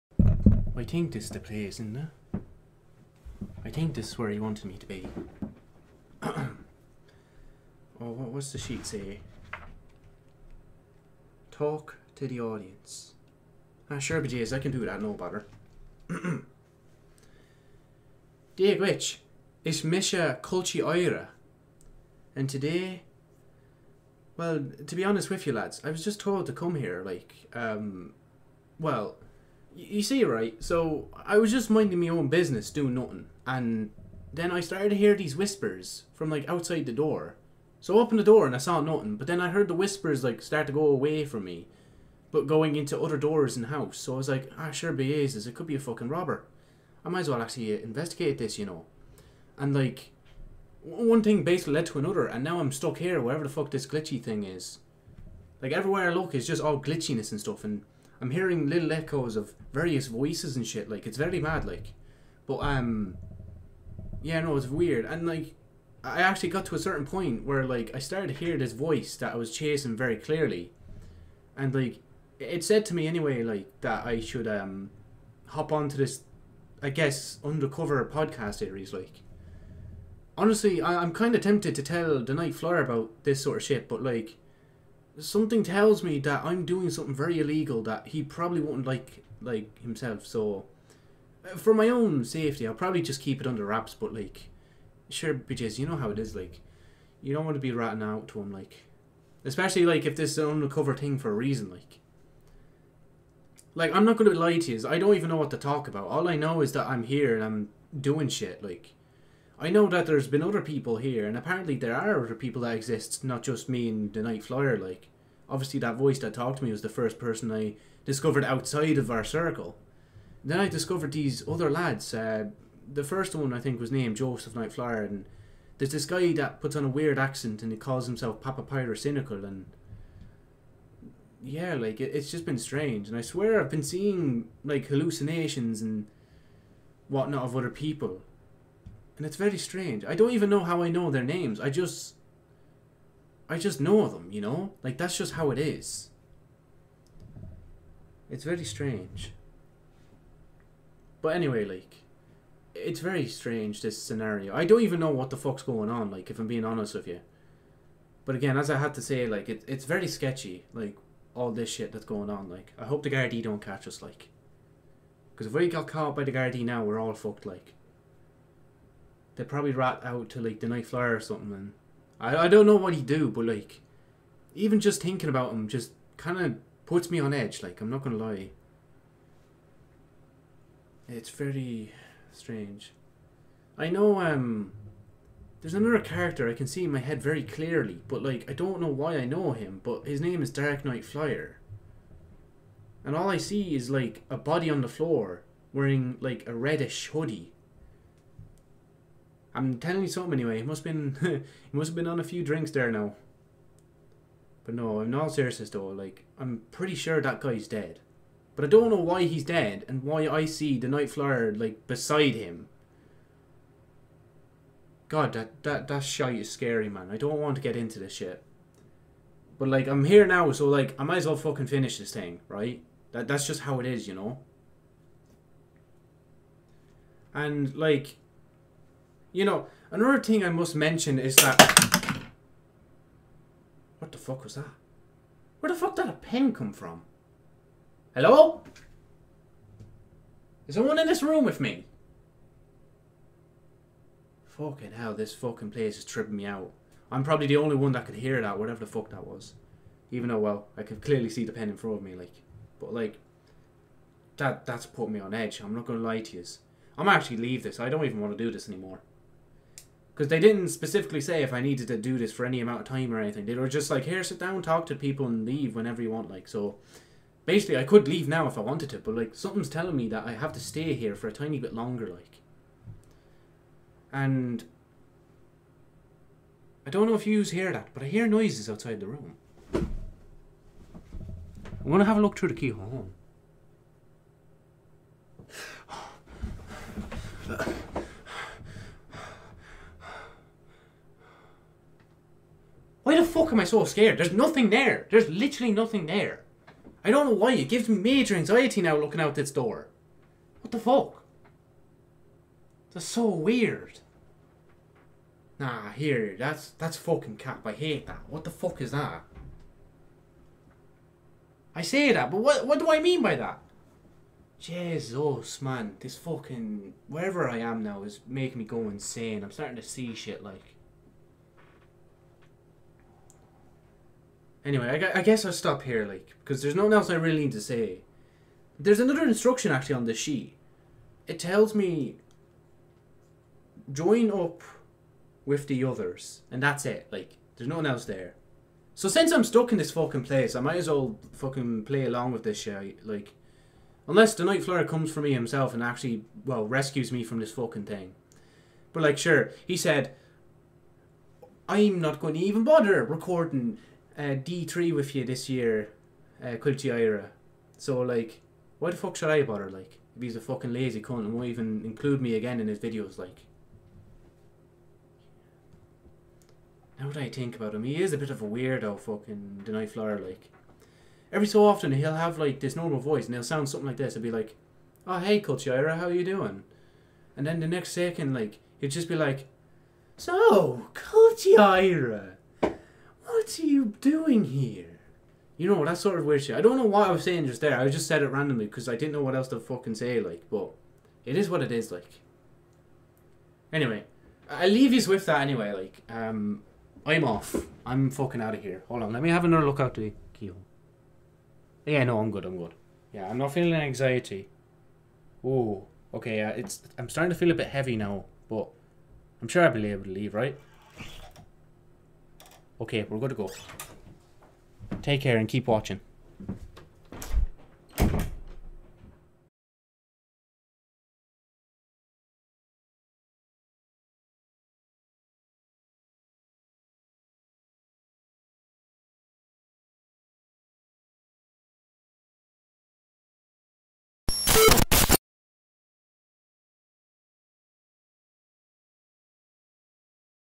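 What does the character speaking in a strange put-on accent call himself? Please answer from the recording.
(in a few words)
Papa Pyrocynical.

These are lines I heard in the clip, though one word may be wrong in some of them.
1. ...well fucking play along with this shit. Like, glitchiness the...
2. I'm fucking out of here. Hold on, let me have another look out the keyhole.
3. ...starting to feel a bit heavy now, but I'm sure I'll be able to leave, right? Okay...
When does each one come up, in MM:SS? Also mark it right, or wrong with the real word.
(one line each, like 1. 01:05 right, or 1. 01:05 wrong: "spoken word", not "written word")
1. 05:40 wrong: "unless", not "glitchiness"
2. 06:37 right
3. 06:47 right.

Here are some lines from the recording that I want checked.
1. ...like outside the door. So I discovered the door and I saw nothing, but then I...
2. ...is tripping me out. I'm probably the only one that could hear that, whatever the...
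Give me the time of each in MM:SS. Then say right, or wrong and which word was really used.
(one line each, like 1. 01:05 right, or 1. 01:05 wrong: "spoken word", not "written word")
1. 00:36 wrong: "opened", not "discovered"
2. 04:05 right.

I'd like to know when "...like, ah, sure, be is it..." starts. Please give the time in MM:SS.
00:44.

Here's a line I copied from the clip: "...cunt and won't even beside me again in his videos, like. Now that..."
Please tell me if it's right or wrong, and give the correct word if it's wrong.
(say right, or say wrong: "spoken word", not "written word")
wrong: "include", not "beside".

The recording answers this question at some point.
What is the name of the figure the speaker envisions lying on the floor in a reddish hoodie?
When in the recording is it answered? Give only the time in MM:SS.
03:10.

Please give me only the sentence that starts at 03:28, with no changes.
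But I don't know why he's dead and why I see the Nite Flyer like beside him.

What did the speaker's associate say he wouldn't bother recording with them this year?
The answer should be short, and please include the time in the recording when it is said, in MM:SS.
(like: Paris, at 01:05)
D3, at 05:54.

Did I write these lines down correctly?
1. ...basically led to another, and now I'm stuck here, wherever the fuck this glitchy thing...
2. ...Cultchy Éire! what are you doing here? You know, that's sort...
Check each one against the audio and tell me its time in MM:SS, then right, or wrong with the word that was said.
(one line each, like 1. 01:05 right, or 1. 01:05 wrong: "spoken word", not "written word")
1. 00:51 right
2. 06:20 right.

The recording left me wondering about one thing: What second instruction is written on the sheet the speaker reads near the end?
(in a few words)
Join up with the others.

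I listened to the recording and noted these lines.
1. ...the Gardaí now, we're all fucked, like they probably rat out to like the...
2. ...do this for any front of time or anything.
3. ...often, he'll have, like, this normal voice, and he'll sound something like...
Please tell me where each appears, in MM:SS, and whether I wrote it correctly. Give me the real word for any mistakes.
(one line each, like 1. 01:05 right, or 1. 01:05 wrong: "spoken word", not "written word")
1. 02:46 right
2. 04:21 wrong: "amount", not "front"
3. 06:11 right.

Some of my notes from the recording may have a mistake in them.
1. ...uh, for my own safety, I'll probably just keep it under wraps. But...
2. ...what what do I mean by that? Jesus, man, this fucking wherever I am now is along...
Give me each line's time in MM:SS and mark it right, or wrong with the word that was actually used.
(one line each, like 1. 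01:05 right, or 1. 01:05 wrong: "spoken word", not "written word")
1. 01:31 right
2. 05:12 wrong: "making", not "along".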